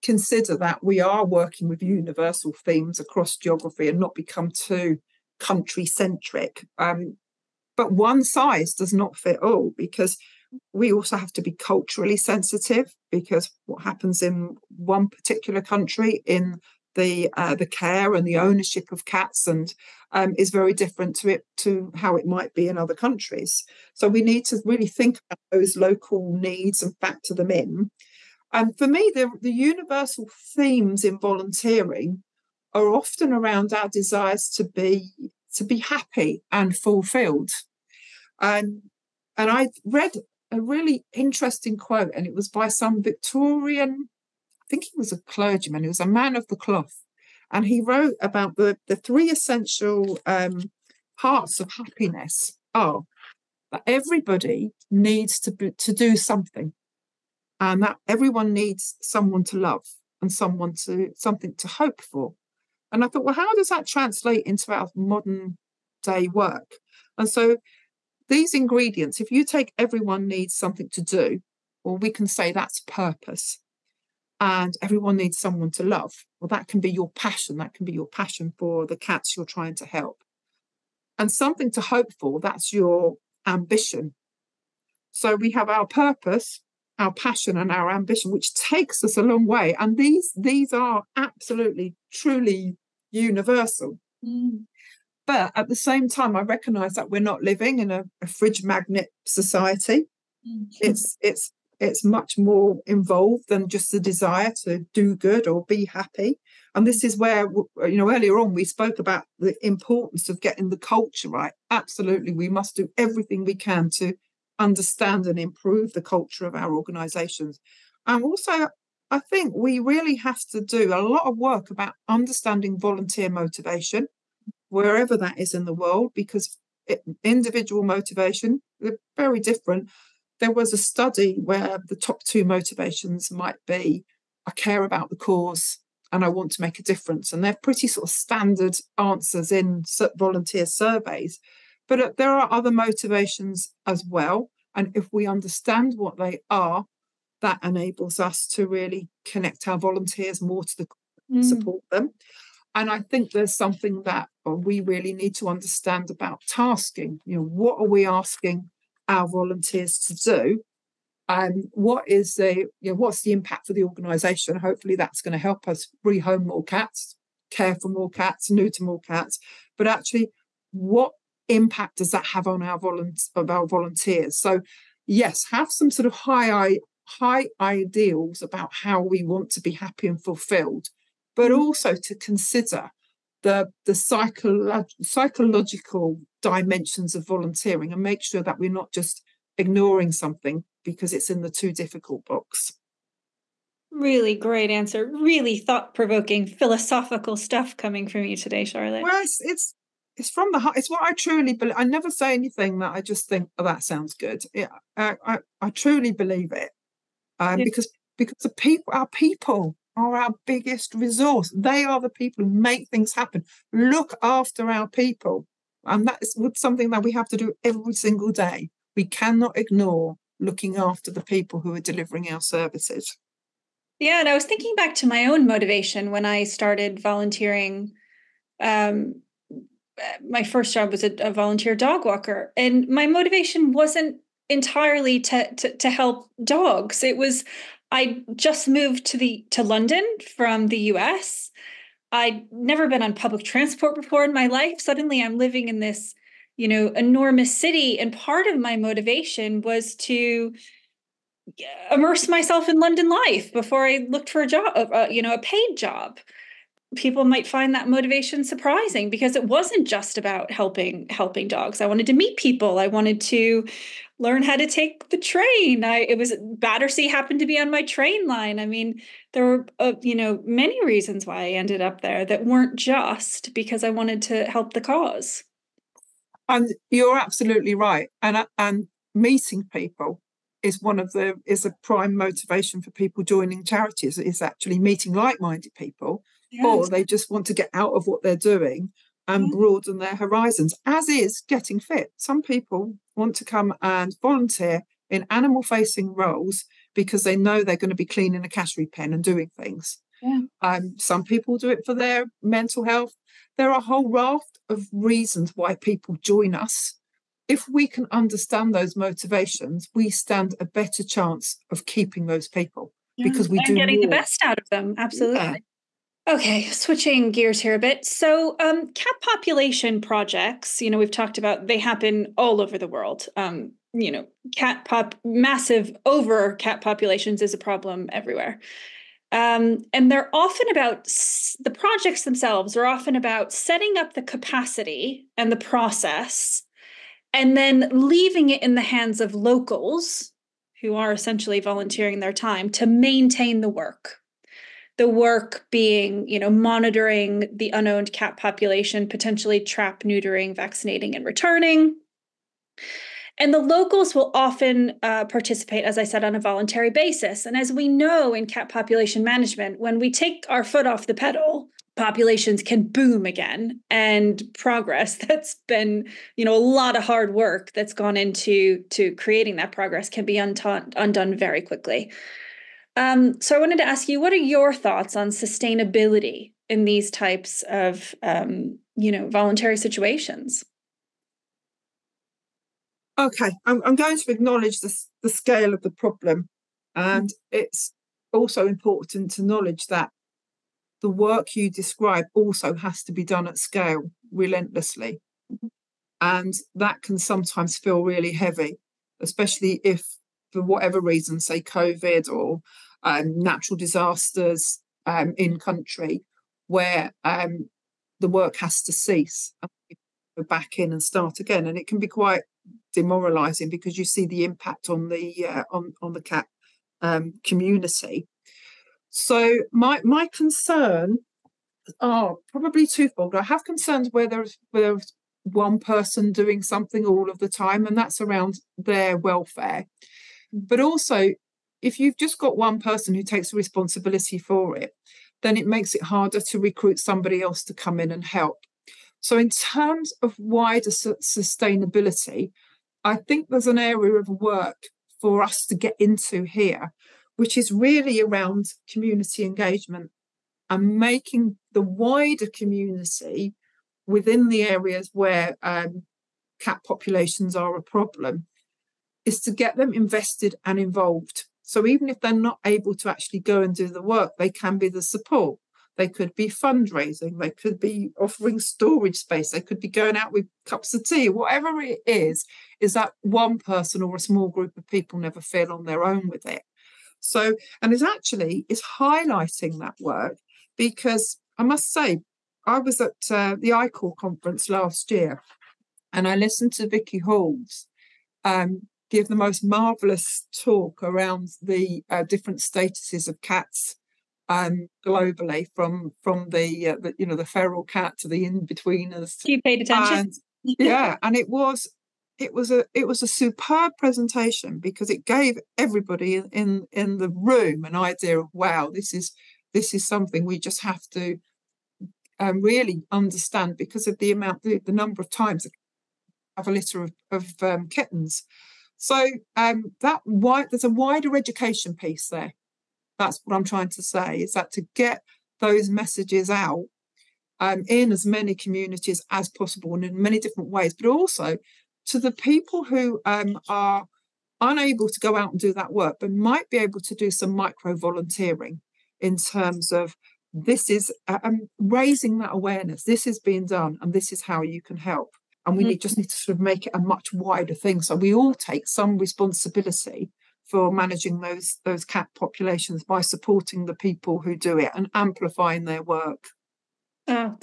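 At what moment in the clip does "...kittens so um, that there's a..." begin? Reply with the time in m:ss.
8:37.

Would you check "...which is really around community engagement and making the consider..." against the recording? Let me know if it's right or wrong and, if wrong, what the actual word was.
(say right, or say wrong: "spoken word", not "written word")
wrong: "wider", not "consider".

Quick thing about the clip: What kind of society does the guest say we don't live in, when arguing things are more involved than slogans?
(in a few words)
A fridge magnet society.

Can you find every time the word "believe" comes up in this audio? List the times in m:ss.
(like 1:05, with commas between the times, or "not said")
3:21, 3:26.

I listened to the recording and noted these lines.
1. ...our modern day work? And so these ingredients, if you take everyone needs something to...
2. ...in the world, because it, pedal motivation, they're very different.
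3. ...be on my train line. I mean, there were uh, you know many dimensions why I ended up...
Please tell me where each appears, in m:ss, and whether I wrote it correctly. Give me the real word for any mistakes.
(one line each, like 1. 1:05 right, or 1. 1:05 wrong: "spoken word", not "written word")
1. 1:04 right
2. 2:05 wrong: "individual", not "pedal"
3. 4:27 wrong: "reasons", not "dimensions".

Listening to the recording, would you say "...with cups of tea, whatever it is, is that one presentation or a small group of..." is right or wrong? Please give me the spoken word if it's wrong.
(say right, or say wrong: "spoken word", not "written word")
wrong: "person", not "presentation".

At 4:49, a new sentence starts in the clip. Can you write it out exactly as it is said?
broaden their horizons, as is getting fit.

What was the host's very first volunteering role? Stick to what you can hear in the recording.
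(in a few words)
Volunteer dog walker.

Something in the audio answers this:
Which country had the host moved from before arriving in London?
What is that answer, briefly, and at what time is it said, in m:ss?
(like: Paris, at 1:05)
The US, at 4:00.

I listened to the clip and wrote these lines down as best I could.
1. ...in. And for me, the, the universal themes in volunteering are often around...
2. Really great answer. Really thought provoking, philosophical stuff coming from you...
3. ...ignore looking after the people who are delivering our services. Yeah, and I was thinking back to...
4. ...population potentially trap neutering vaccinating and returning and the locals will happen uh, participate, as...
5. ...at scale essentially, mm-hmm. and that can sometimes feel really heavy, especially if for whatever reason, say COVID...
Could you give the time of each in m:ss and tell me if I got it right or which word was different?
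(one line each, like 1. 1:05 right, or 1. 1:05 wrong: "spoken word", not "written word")
1. 0:27 right
2. 3:13 right
3. 3:39 right
4. 5:48 wrong: "often", not "happen"
5. 6:33 wrong: "relentlessly", not "essentially".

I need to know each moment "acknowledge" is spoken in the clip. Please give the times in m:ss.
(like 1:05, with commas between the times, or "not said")
6:24, 6:29.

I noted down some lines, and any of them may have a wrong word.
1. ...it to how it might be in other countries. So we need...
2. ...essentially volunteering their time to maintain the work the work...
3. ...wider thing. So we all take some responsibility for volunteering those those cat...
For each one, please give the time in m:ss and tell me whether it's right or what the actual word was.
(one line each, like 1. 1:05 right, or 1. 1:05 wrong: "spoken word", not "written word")
1. 0:21 right
2. 5:41 right
3. 9:07 wrong: "managing", not "volunteering".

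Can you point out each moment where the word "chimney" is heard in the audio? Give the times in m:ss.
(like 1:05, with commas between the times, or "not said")
not said.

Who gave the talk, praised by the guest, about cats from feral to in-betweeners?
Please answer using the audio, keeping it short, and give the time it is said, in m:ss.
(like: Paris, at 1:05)
Vicky Halls, at 8:06.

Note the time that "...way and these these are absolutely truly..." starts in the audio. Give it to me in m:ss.
1:29.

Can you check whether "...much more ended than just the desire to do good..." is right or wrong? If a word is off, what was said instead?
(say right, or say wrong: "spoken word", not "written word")
wrong: "involved", not "ended".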